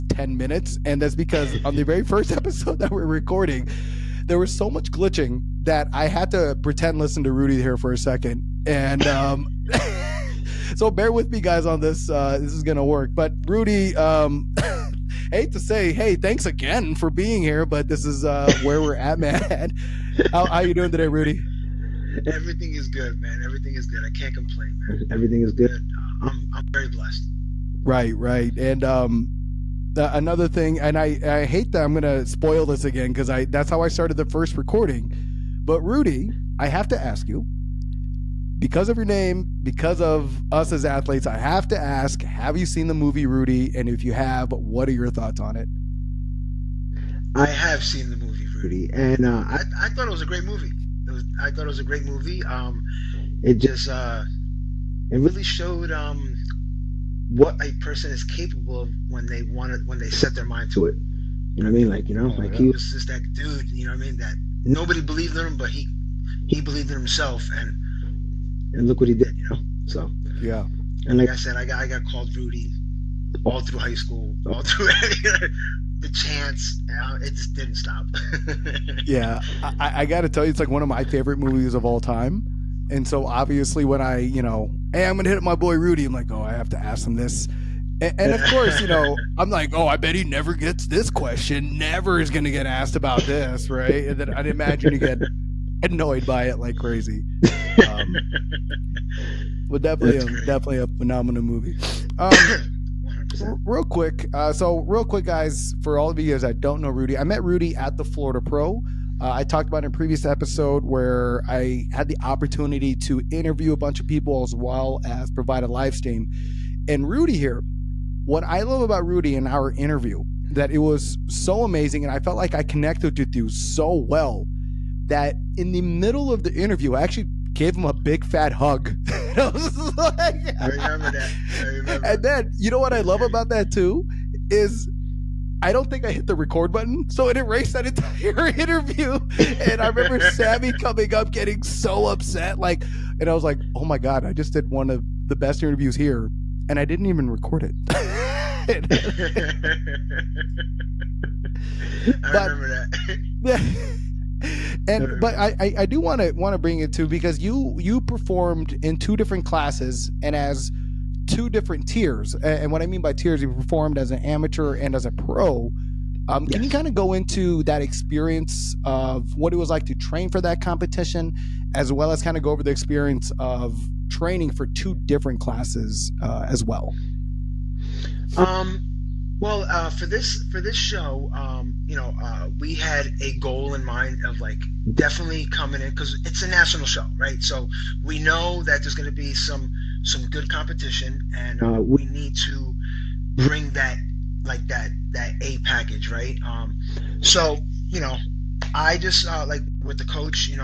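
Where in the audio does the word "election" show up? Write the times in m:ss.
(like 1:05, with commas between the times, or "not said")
not said.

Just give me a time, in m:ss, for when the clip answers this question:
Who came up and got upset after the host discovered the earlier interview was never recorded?
2:20.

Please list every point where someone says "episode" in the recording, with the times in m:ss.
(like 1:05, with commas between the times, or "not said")
0:02, 1:50.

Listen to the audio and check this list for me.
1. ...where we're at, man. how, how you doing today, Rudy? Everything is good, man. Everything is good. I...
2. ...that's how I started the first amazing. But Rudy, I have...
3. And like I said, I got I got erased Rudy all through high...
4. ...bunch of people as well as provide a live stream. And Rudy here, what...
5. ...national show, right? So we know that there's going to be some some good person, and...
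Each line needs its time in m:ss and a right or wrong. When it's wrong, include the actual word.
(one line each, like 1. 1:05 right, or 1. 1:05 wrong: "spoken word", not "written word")
1. 0:18 right
2. 0:33 wrong: "recording", not "amazing"
3. 1:11 wrong: "called", not "erased"
4. 1:53 right
5. 3:06 wrong: "competition", not "person".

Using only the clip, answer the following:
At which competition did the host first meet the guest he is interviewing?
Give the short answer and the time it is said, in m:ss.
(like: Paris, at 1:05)
Florida Pro, at 1:48.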